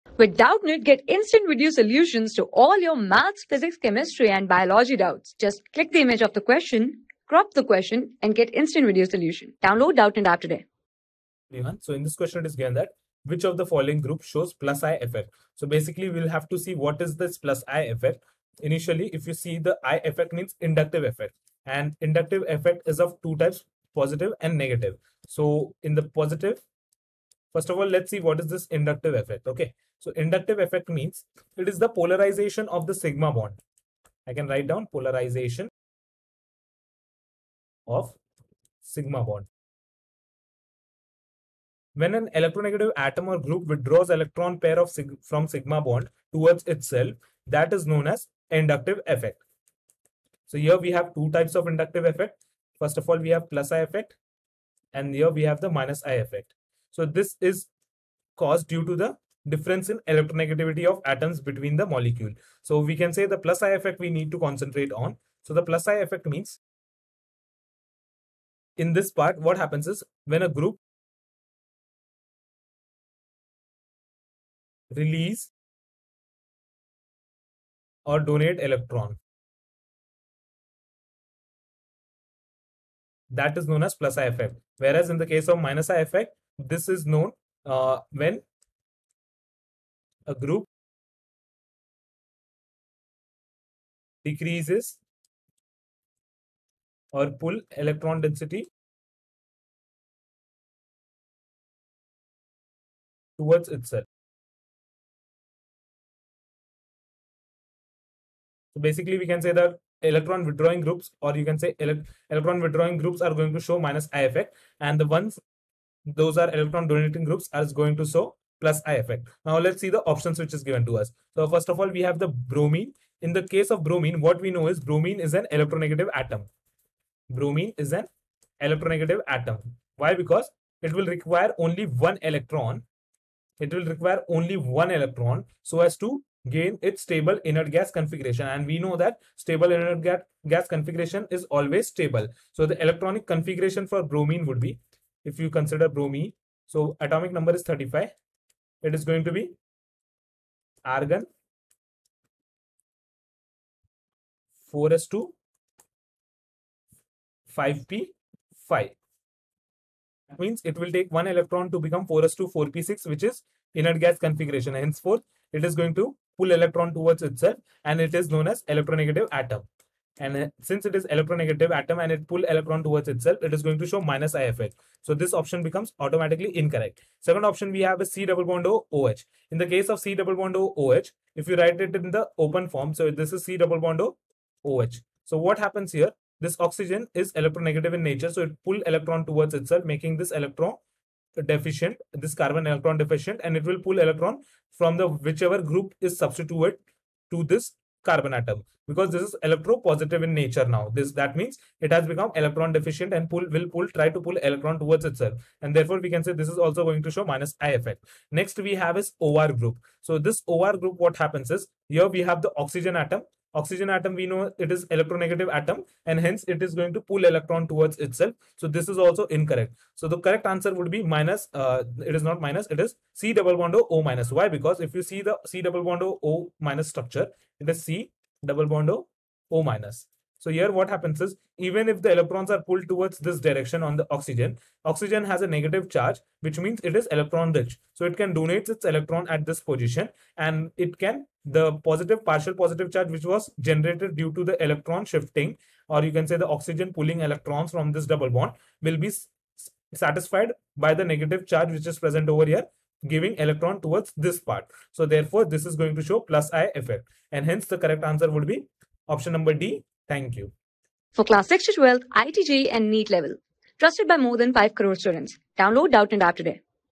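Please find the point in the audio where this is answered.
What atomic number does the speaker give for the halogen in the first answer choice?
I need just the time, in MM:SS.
02:27.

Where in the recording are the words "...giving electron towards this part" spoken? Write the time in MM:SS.
04:13.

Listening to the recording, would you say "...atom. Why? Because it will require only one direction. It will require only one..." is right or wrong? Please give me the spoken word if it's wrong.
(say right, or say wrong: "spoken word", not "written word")
wrong: "electron", not "direction".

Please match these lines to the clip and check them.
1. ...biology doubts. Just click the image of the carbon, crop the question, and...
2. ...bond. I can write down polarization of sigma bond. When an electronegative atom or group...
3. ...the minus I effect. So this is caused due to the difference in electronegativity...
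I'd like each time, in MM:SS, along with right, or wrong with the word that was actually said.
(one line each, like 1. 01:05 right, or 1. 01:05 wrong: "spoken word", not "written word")
1. 00:04 wrong: "question", not "carbon"
2. 00:33 right
3. 00:55 right.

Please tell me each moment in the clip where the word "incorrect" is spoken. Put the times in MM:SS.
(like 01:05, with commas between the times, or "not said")
02:56, 03:39.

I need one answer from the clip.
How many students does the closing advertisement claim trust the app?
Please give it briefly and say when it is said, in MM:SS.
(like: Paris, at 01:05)
More than 5 crore, at 04:24.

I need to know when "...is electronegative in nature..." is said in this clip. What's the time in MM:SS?
03:07.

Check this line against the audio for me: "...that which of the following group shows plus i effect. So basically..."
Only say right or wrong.
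right.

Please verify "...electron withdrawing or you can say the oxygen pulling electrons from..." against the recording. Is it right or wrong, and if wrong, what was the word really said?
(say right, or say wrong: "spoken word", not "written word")
wrong: "shifting", not "withdrawing".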